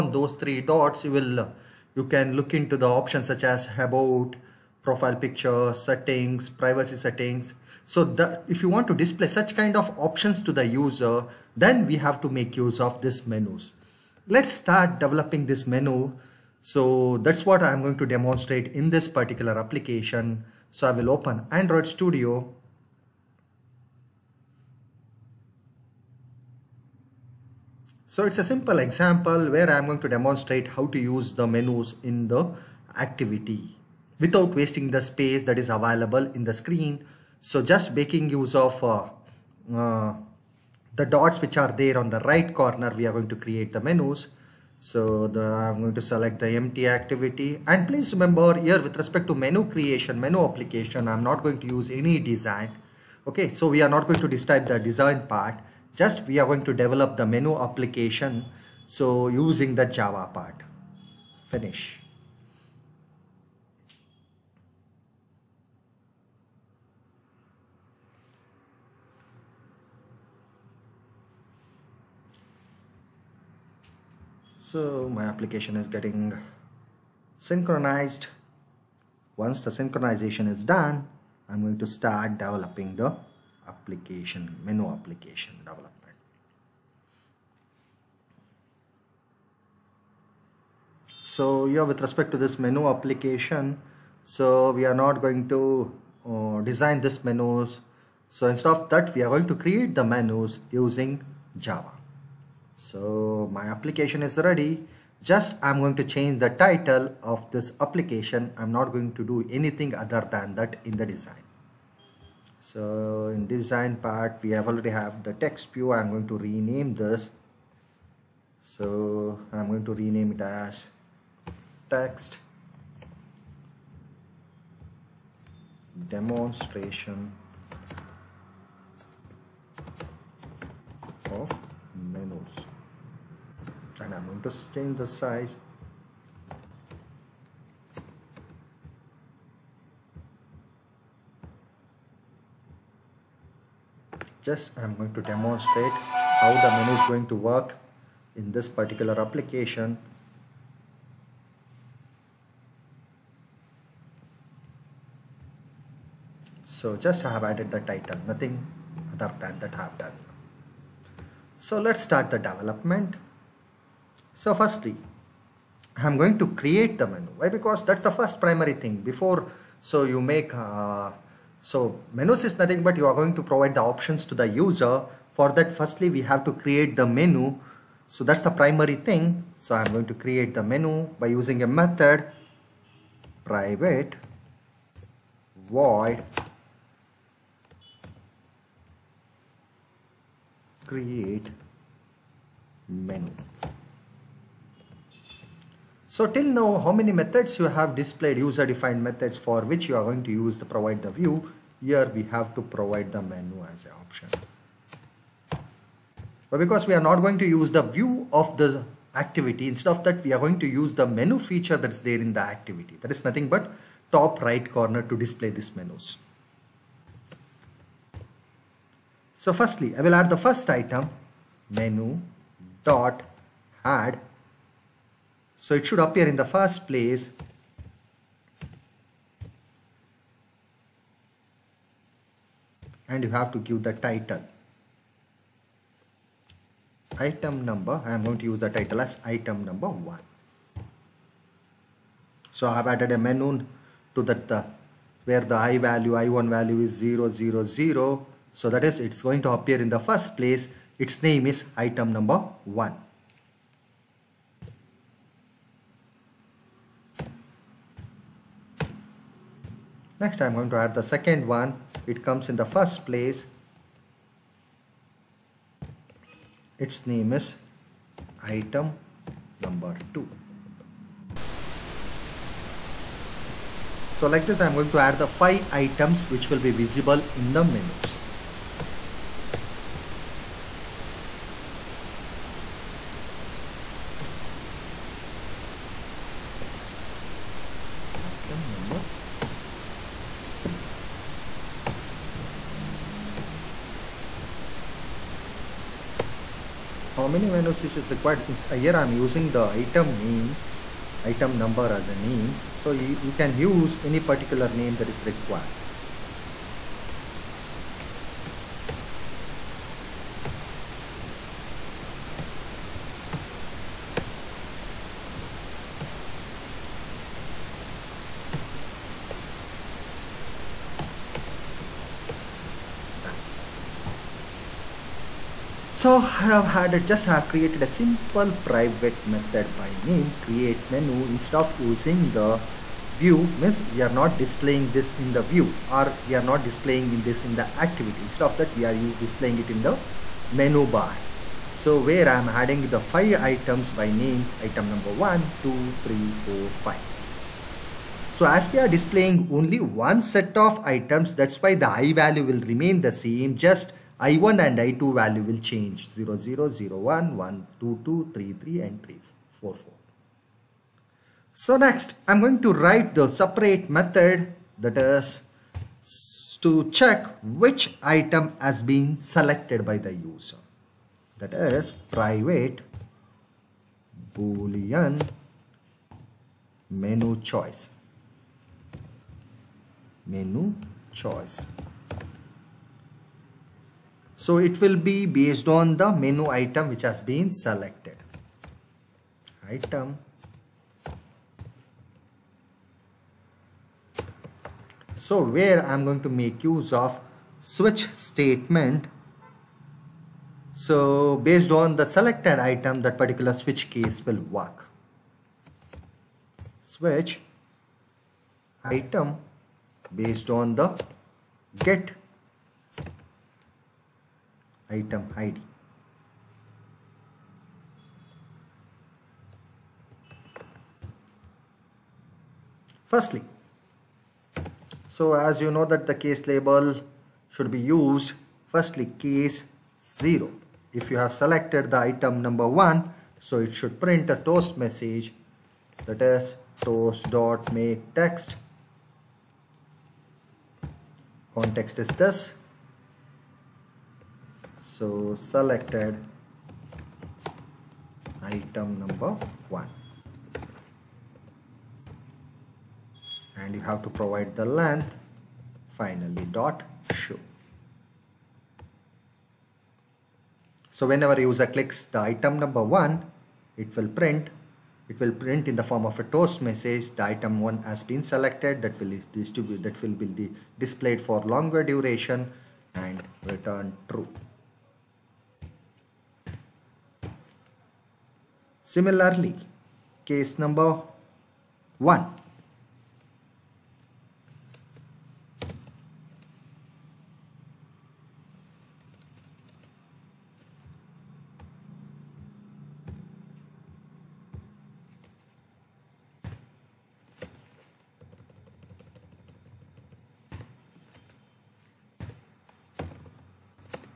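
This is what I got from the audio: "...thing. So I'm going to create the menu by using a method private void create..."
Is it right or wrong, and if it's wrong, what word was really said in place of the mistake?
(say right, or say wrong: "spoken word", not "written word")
right.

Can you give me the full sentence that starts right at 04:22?
It comes in the first place.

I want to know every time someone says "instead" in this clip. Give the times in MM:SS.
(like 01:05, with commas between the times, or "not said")
01:38, 03:29, 05:31, 05:38.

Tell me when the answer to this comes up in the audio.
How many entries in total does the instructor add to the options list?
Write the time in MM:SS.
04:35.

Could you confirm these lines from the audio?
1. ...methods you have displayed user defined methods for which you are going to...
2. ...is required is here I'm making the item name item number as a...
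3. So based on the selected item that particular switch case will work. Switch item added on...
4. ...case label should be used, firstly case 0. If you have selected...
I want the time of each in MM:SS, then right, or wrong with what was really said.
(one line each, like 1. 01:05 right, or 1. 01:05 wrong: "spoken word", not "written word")
1. 03:17 right
2. 04:57 wrong: "using", not "making"
3. 06:40 wrong: "based", not "added"
4. 07:06 right.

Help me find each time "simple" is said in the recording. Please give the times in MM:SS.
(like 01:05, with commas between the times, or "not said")
00:28, 05:27.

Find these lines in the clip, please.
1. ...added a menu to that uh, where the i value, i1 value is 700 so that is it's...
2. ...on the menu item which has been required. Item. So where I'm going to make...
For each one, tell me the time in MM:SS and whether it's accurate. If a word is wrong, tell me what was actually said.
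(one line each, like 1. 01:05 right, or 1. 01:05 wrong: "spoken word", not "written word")
1. 04:02 wrong: "000", not "700"
2. 06:25 wrong: "selected", not "required".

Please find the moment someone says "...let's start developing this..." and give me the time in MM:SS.
00:14.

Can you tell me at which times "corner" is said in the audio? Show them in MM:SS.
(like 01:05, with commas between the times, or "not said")
00:42, 03:34.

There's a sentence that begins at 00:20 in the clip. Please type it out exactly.
So I will open Android Studio.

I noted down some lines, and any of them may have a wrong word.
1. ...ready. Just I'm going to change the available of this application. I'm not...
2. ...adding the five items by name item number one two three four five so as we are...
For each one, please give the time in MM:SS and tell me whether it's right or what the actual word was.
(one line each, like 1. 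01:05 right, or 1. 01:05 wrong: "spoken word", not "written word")
1. 01:44 wrong: "title", not "available"
2. 05:42 right.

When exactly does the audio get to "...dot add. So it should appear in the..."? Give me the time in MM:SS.
03:42.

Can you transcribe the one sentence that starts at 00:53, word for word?
Okay, so we are not going to describe the design part, just we are going to develop the menu application.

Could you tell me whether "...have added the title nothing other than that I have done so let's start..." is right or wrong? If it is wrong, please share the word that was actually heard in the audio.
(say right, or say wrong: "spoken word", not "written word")
right.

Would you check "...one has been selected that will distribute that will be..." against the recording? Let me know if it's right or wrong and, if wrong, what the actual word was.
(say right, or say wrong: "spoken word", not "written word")
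right.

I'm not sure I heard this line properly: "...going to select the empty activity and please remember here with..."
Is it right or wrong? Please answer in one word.
right.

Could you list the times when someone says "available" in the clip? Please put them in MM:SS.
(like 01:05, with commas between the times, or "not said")
00:35.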